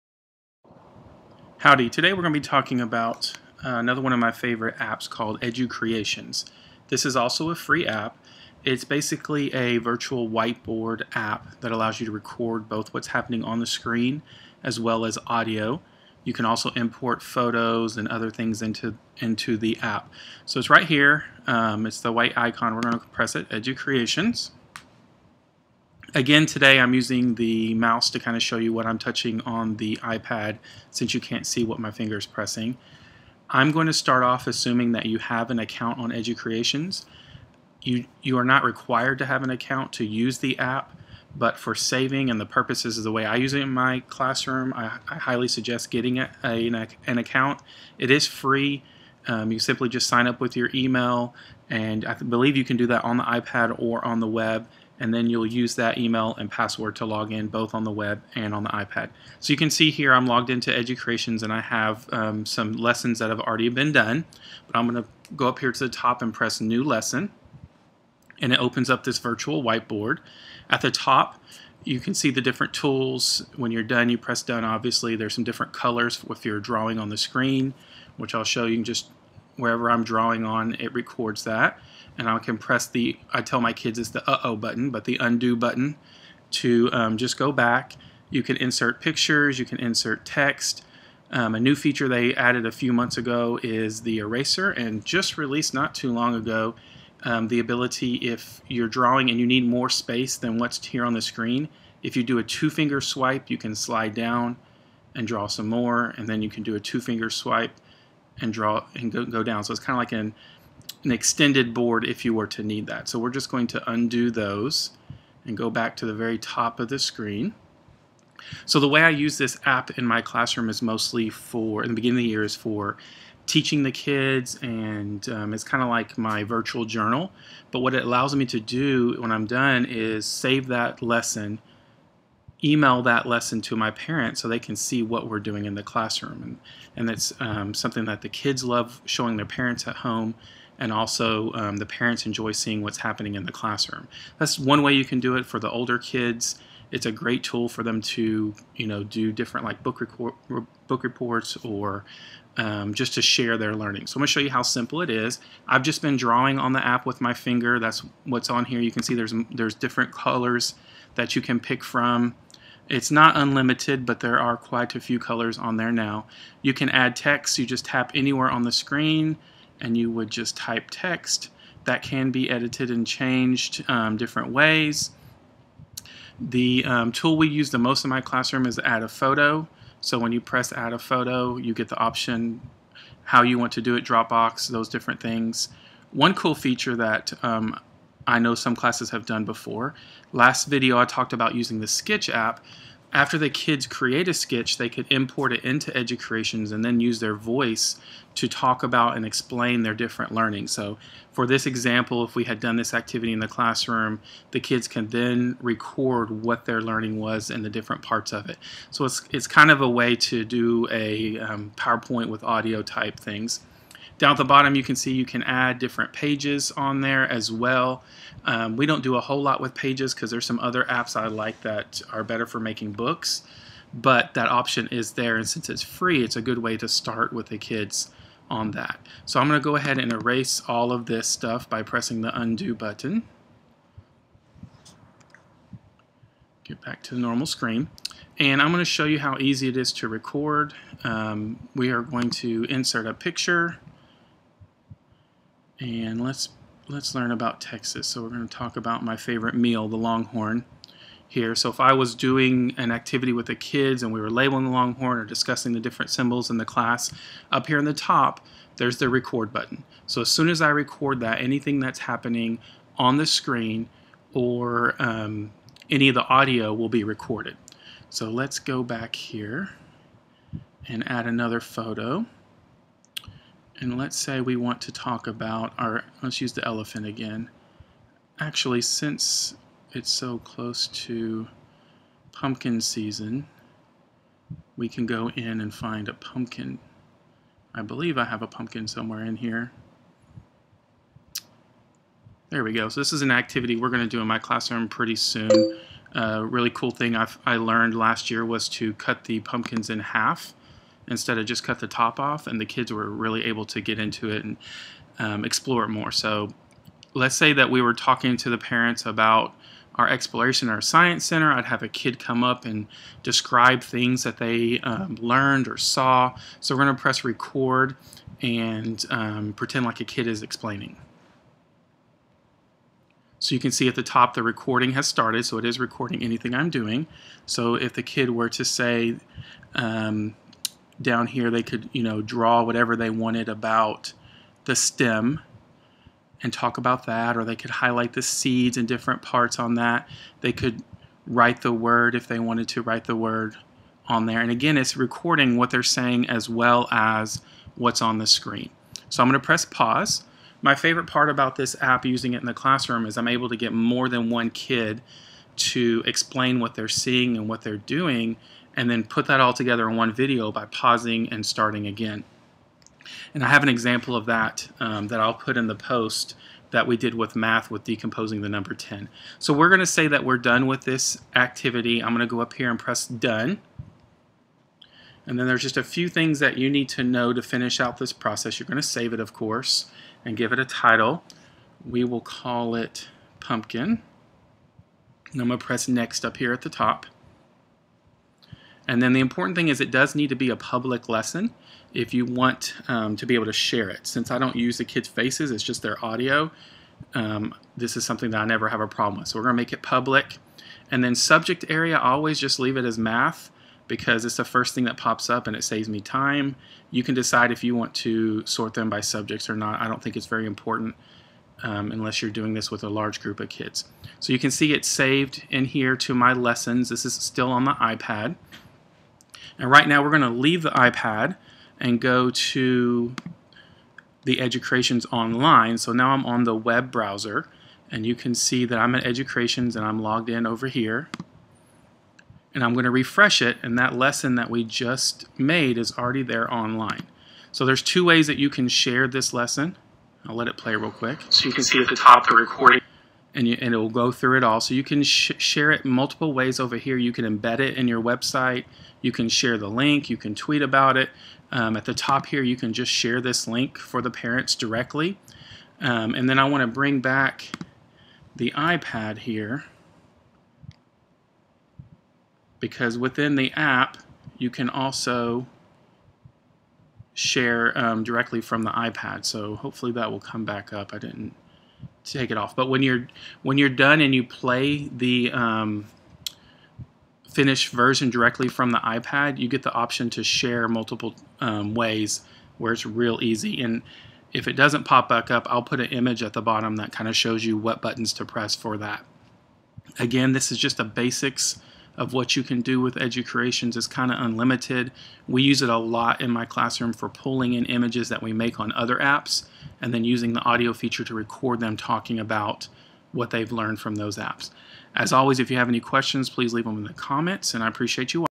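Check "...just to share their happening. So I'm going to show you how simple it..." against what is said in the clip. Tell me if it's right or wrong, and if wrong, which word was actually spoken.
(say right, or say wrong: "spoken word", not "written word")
wrong: "learning", not "happening".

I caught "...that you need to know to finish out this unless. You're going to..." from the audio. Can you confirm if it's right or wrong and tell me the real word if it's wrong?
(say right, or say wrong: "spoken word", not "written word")
wrong: "process", not "unless".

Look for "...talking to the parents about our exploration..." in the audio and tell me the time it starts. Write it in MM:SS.
05:07.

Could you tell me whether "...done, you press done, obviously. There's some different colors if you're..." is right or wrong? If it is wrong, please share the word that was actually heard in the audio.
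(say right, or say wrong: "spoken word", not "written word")
right.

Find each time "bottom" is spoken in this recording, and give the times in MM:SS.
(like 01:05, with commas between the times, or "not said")
03:34, 08:06.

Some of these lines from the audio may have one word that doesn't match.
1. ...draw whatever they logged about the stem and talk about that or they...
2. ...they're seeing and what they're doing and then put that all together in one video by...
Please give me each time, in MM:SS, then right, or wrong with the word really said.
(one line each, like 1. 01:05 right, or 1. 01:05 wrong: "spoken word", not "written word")
1. 05:32 wrong: "wanted", not "logged"
2. 05:56 right.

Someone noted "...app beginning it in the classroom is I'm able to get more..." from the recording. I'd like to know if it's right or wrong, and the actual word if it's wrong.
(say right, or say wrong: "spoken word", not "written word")
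wrong: "using", not "beginning".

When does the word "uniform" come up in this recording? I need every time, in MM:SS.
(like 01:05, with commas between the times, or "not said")
not said.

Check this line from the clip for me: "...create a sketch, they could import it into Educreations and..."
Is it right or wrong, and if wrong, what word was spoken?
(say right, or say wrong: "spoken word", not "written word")
right.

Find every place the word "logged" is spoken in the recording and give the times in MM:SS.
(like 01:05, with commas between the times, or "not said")
01:00, 07:10.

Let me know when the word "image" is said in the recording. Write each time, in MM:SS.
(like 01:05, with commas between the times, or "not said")
08:05, 08:17.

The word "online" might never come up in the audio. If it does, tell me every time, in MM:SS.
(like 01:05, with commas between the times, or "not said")
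07:05, 07:16.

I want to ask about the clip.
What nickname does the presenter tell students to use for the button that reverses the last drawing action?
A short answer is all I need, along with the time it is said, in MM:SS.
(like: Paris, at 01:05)
uh-oh button, at 01:24.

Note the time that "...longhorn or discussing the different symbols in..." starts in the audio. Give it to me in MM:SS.
04:14.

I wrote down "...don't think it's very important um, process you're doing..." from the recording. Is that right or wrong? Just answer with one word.
wrong.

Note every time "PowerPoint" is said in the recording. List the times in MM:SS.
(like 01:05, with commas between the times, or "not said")
03:31.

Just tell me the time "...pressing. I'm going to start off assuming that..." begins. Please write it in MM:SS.
00:32.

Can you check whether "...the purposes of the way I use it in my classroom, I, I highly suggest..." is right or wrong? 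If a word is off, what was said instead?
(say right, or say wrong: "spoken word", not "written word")
right.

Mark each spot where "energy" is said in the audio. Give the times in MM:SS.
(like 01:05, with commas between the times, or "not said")
not said.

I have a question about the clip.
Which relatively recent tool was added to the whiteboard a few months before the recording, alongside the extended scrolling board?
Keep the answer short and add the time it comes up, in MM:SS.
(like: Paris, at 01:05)
eraser, at 01:34.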